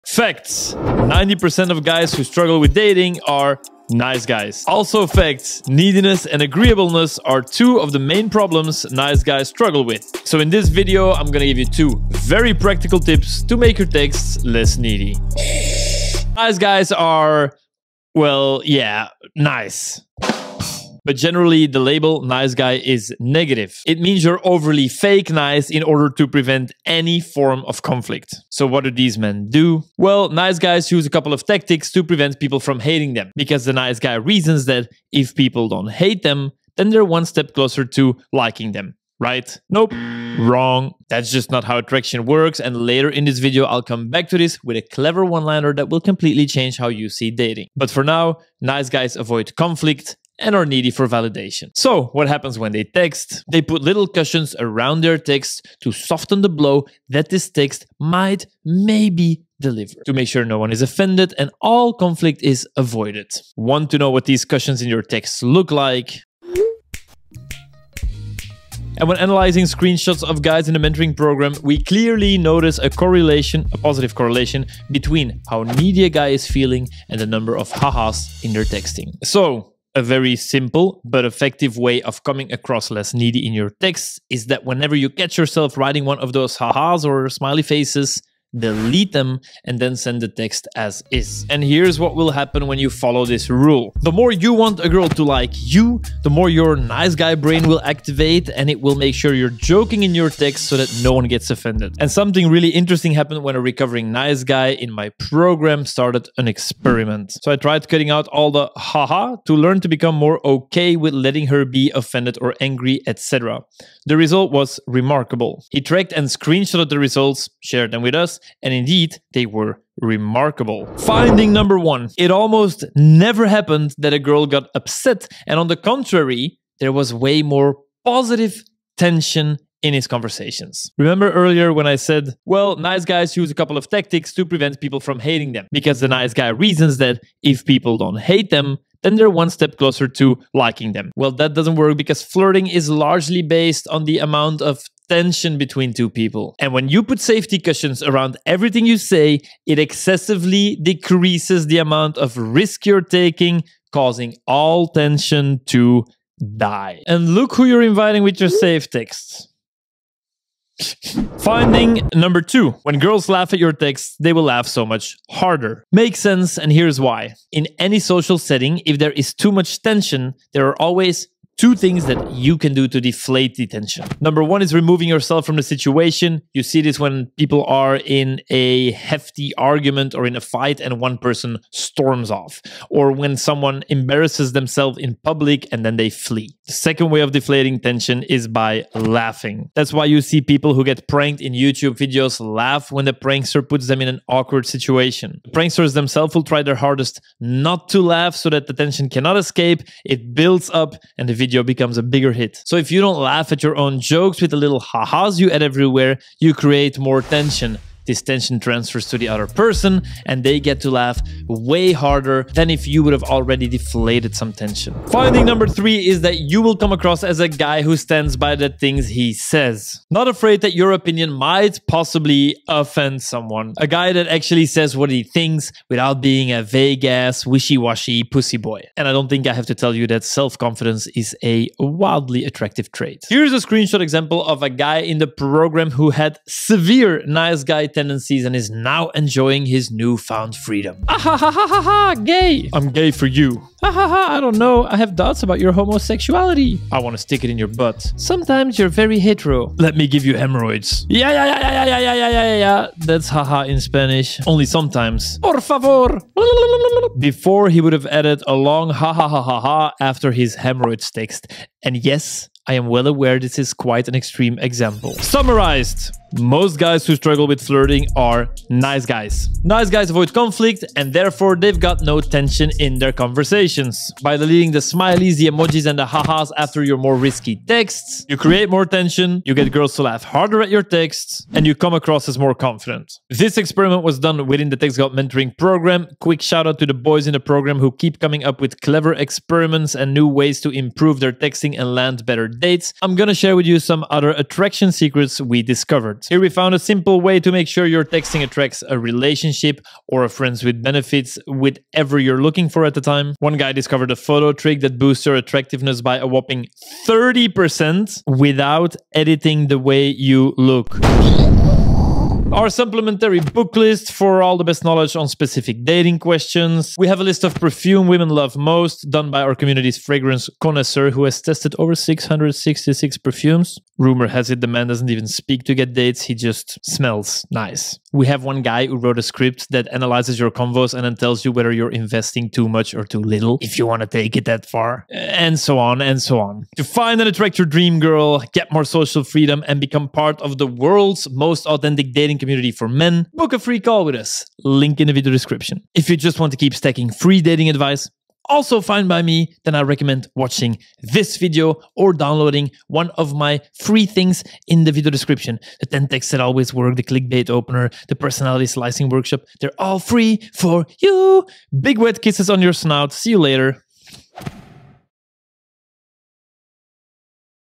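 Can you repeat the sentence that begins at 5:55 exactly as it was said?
The 10 texts that always work, the clickbait opener, the personality slicing workshop, they're all free for you.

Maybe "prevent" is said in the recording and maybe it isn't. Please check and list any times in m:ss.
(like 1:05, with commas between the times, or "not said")
0:26, 0:32, 2:14.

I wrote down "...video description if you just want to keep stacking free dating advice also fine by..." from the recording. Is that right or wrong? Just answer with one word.
right.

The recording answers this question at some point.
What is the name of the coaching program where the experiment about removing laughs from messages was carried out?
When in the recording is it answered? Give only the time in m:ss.
4:44.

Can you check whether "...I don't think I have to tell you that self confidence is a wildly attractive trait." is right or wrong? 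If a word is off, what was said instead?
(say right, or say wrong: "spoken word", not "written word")
right.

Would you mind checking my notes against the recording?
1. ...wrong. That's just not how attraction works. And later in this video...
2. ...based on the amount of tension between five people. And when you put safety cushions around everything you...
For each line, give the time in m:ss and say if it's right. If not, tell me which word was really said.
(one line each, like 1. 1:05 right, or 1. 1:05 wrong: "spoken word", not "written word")
1. 0:40 right
2. 2:23 wrong: "two", not "five".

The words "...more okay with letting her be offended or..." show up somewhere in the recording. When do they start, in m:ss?
1:50.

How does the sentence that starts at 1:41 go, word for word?
And something really interesting happened when a recovering nice guy in my program started an experiment.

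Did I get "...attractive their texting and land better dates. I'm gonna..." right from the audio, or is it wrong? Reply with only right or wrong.
wrong.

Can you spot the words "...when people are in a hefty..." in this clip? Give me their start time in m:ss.
2:56.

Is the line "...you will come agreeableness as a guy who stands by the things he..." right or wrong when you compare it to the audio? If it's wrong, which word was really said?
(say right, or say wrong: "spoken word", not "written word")
wrong: "across", not "agreeableness".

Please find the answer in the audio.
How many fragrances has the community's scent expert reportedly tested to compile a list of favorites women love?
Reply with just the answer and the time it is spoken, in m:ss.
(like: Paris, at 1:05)
666, at 5:21.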